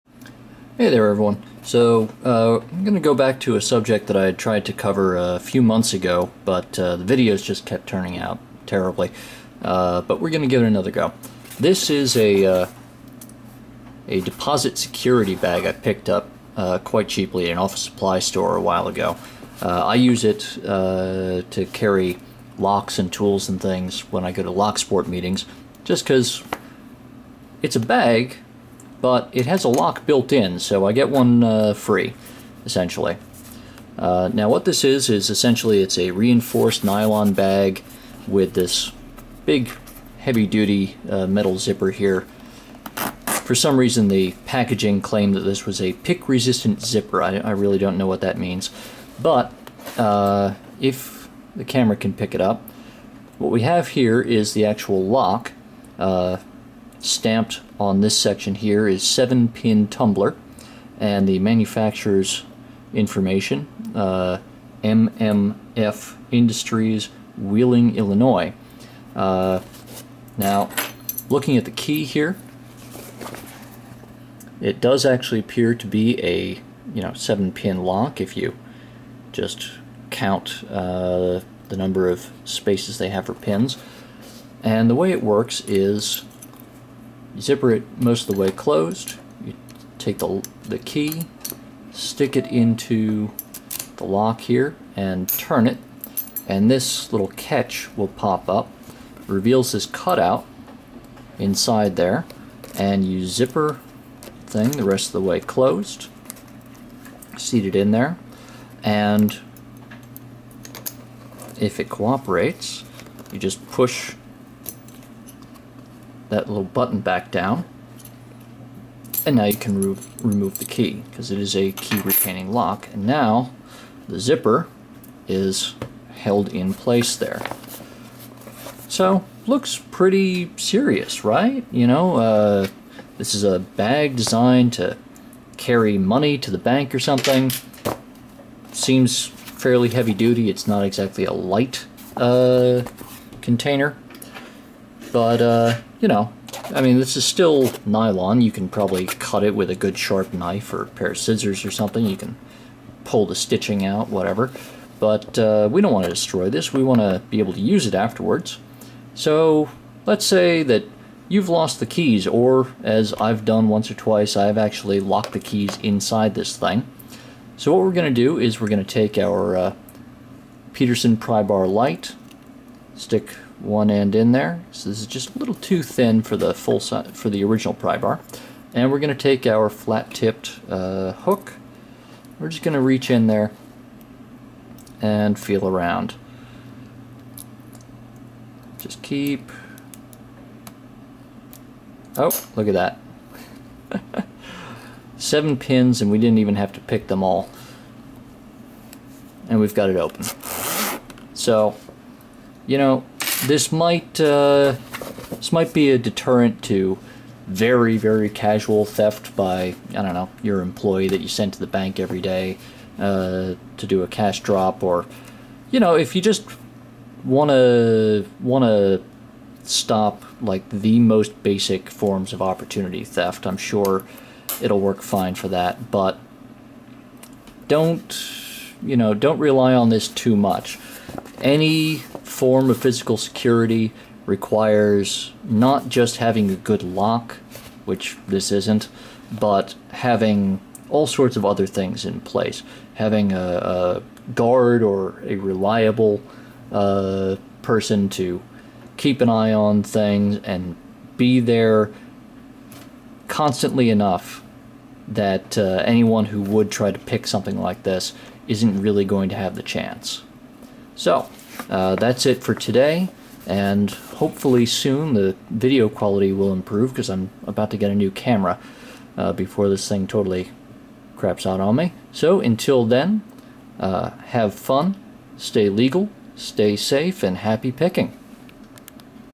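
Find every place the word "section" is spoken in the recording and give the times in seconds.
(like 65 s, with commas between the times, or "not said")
58 s.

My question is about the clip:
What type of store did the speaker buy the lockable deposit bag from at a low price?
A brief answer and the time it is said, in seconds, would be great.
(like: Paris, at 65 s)
office supply store, at 17 s.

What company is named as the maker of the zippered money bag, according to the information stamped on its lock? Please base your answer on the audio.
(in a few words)
MMF Industries.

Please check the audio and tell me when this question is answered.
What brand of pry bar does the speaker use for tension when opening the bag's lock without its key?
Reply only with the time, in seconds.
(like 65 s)
170 s.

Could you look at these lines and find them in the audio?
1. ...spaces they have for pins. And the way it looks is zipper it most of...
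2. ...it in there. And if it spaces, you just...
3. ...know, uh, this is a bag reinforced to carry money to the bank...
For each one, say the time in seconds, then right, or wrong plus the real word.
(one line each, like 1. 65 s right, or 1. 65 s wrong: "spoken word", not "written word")
1. 82 s wrong: "works", not "looks"
2. 107 s wrong: "cooperates", not "spaces"
3. 131 s wrong: "designed", not "reinforced".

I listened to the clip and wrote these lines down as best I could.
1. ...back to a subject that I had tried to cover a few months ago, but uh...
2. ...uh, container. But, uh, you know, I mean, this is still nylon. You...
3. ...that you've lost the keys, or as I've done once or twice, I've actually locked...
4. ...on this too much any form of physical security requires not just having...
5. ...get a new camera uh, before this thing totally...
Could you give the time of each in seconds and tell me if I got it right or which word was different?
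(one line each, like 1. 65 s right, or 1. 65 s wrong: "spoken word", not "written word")
1. 3 s right
2. 142 s right
3. 160 s right
4. 229 s right
5. 267 s right.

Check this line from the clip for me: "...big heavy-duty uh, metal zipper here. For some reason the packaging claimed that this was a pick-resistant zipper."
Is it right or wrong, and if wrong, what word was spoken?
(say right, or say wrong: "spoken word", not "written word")
right.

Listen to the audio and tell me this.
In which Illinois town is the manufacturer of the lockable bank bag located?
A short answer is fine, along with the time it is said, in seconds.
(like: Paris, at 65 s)
Wheeling, at 67 s.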